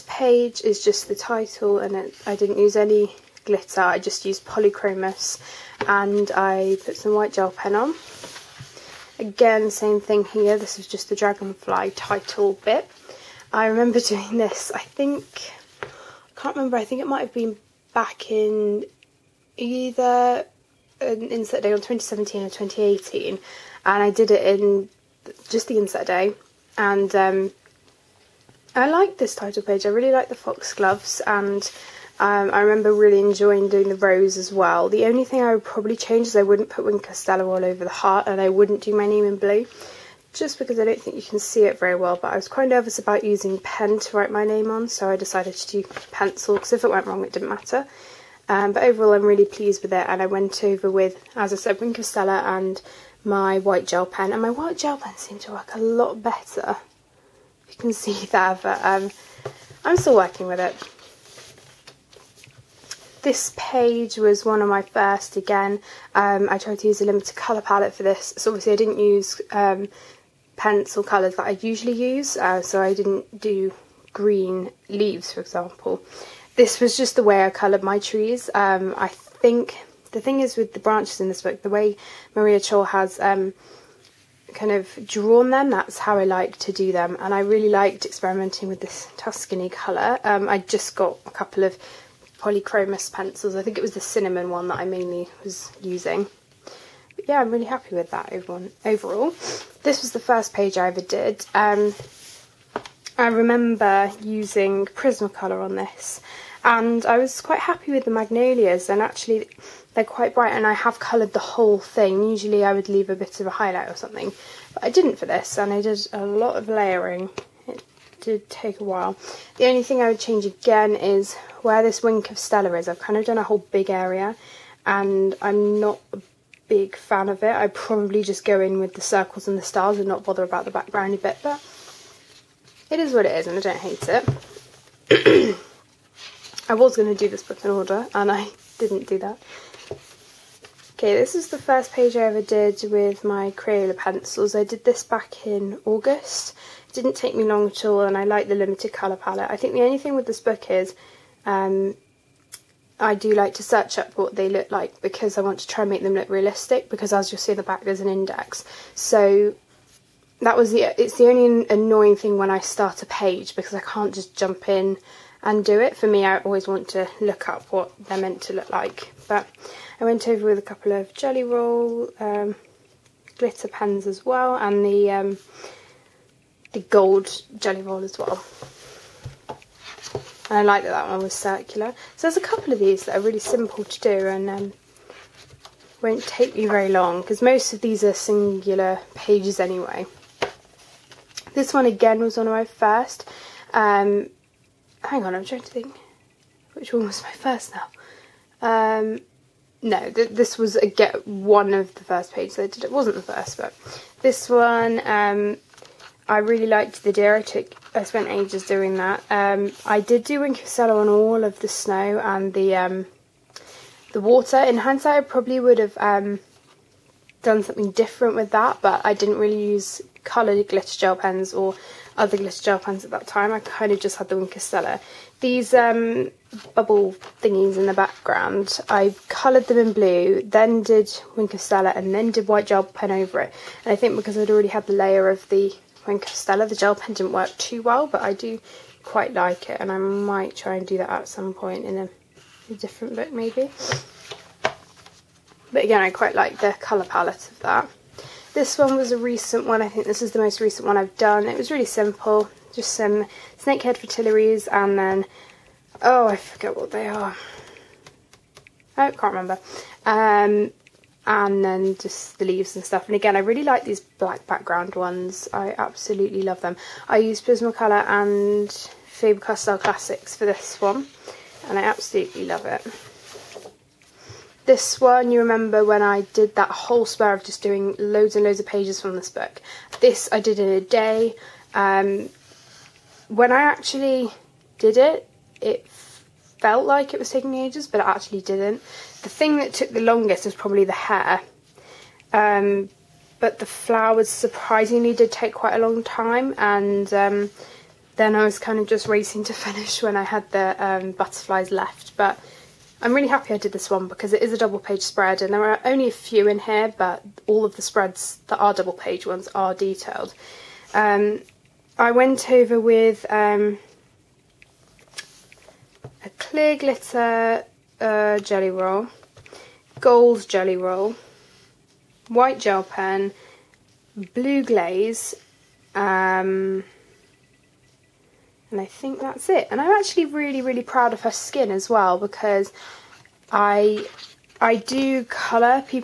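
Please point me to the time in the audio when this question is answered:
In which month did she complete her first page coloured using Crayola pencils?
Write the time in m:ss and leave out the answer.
2:25.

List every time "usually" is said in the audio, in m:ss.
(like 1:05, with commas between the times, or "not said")
1:11, 1:52.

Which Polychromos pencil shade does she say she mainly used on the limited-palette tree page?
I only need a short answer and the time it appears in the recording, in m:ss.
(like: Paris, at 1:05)
cinnamon, at 1:34.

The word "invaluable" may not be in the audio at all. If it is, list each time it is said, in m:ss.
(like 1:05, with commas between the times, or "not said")
not said.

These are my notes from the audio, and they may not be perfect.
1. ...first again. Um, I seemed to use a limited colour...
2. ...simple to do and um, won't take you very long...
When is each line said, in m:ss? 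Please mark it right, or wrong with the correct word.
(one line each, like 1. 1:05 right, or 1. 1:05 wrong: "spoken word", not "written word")
1. 1:04 wrong: "tried", not "seemed"
2. 3:03 right.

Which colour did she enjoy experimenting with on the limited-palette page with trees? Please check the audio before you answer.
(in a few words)
Tuscany.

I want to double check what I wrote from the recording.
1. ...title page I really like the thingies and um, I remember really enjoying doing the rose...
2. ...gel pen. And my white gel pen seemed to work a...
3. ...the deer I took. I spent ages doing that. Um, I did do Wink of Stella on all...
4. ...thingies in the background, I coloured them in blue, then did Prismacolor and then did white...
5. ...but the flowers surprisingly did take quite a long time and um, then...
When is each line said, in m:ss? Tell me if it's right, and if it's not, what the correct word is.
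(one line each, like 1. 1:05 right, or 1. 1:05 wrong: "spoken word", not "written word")
1. 0:29 wrong: "foxgloves", not "thingies"
2. 0:53 right
3. 3:27 right
4. 3:47 wrong: "Winker", not "Prismacolor"
5. 4:53 right.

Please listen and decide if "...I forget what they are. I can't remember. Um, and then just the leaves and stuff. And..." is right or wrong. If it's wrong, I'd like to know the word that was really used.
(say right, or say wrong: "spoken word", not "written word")
right.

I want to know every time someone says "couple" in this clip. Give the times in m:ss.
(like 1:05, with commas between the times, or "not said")
1:31, 2:50, 3:02.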